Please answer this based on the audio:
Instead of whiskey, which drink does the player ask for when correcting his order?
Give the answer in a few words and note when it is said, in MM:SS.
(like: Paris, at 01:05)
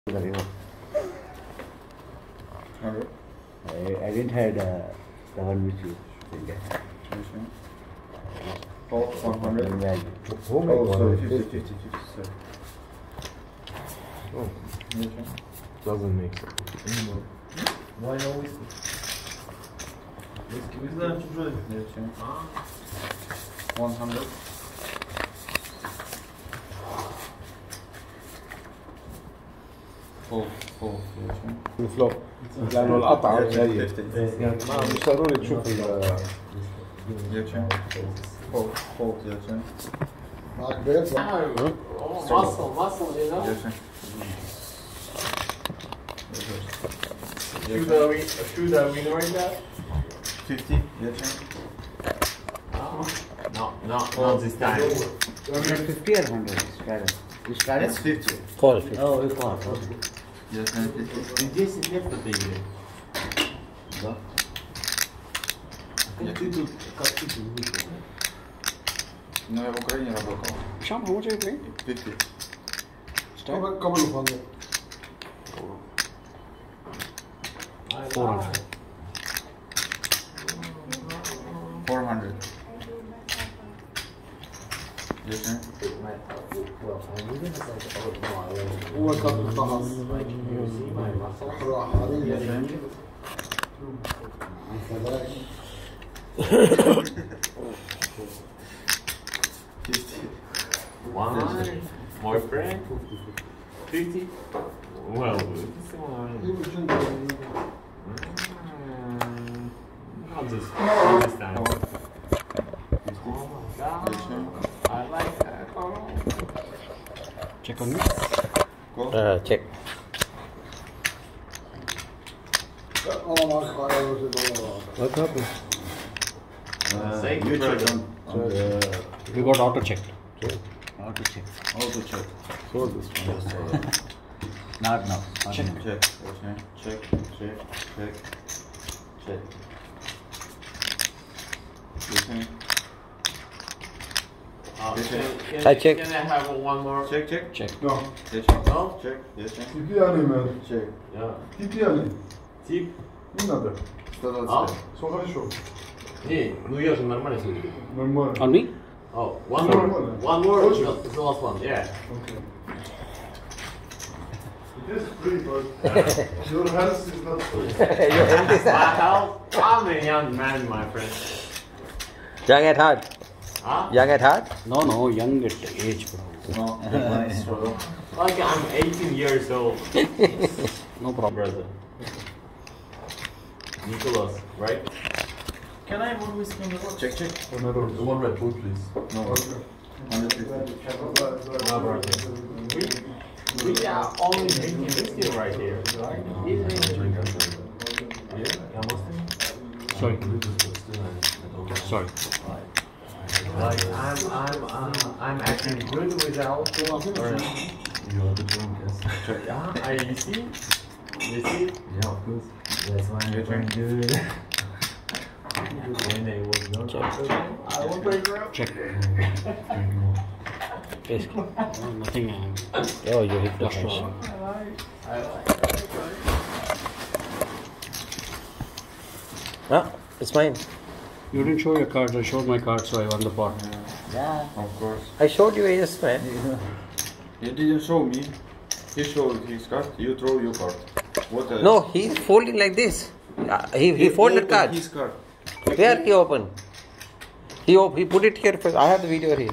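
Red Bull, at 03:08.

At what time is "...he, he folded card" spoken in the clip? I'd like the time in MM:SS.
04:03.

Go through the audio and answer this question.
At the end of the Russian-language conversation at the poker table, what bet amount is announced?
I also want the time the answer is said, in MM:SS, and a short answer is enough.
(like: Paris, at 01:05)
400, at 01:20.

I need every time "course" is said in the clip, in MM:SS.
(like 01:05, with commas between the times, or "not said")
03:32, 03:54.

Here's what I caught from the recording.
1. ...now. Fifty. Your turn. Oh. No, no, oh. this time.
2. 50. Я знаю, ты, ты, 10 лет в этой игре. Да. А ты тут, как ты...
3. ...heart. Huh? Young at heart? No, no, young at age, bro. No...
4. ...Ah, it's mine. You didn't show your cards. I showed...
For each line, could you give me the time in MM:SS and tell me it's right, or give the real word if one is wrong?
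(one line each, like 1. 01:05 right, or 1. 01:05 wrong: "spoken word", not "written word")
1. 00:49 right
2. 00:58 right
3. 02:52 right
4. 03:49 right.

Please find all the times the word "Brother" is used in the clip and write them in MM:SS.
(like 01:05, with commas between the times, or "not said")
03:01.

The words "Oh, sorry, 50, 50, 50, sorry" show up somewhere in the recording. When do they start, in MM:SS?
00:10.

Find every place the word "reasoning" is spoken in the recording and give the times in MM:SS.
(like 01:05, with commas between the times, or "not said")
not said.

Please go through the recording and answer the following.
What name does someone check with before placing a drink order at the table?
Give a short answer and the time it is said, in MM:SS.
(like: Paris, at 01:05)
Nicholas, at 03:03.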